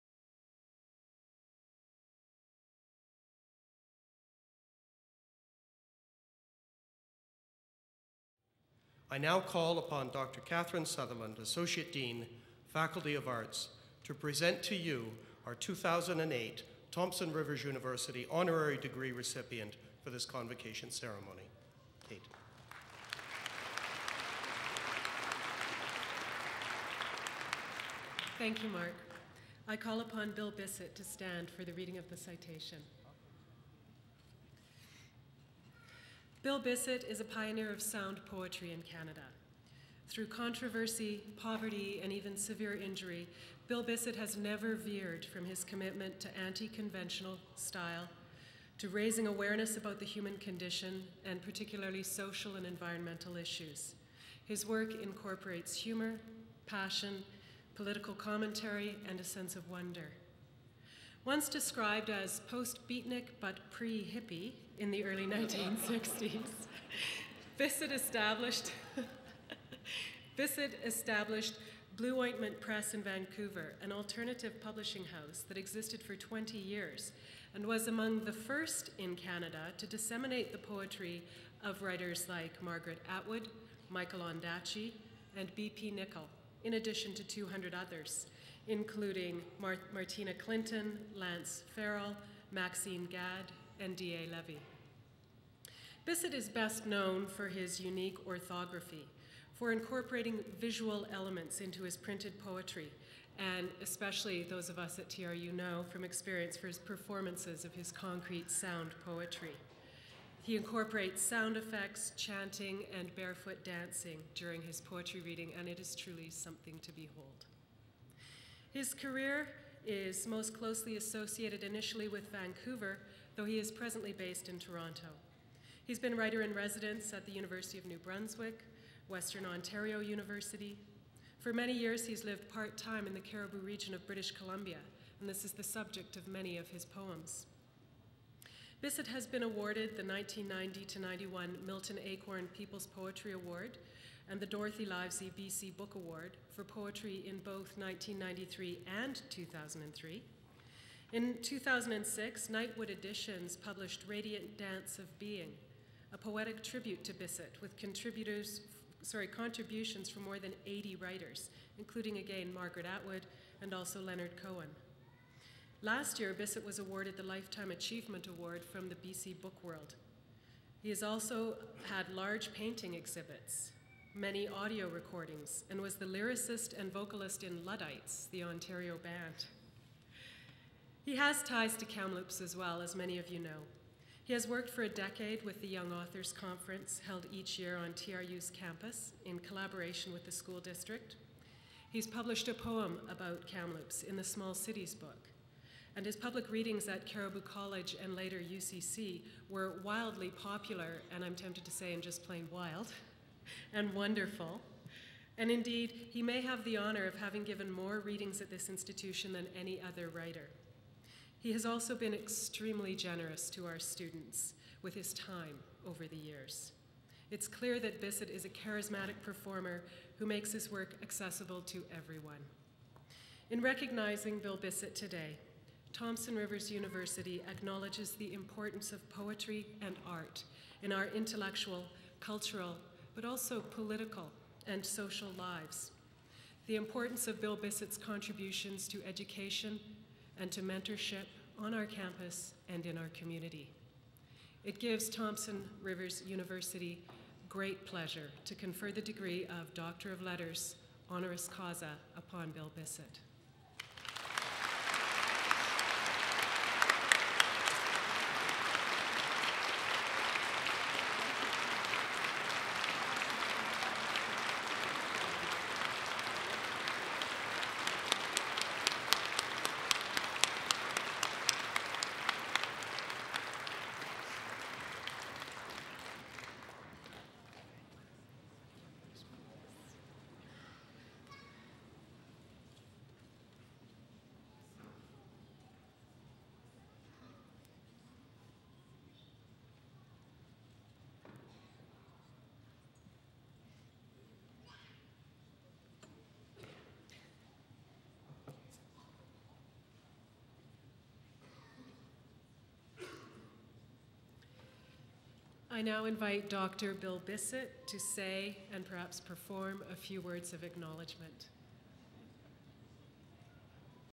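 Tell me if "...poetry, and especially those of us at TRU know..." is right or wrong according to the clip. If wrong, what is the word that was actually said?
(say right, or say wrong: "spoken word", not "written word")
right.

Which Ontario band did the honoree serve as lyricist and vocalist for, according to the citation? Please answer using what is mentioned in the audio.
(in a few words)
Luddites.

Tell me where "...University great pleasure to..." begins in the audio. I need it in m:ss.
4:06.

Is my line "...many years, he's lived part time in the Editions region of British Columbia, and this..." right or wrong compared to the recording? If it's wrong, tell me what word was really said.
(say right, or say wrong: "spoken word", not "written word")
wrong: "Cariboo", not "Editions".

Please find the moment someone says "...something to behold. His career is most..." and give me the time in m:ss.
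1:56.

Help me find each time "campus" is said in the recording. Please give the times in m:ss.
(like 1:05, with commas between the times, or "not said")
3:08, 4:01.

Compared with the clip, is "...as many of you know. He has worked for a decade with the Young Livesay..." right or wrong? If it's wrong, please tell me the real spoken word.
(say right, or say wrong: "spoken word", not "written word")
wrong: "Authors", not "Livesay".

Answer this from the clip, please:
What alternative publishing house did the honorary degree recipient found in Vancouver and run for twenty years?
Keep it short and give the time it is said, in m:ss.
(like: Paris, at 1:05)
Blewointment Press, at 1:11.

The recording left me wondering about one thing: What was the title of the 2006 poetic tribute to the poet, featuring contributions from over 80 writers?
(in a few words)
Radiant Dance of Being.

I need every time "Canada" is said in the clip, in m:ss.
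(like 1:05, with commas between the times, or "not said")
0:38, 1:19.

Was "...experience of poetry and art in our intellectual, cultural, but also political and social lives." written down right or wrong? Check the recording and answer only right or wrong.
wrong.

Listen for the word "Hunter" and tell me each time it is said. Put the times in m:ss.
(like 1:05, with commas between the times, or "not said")
not said.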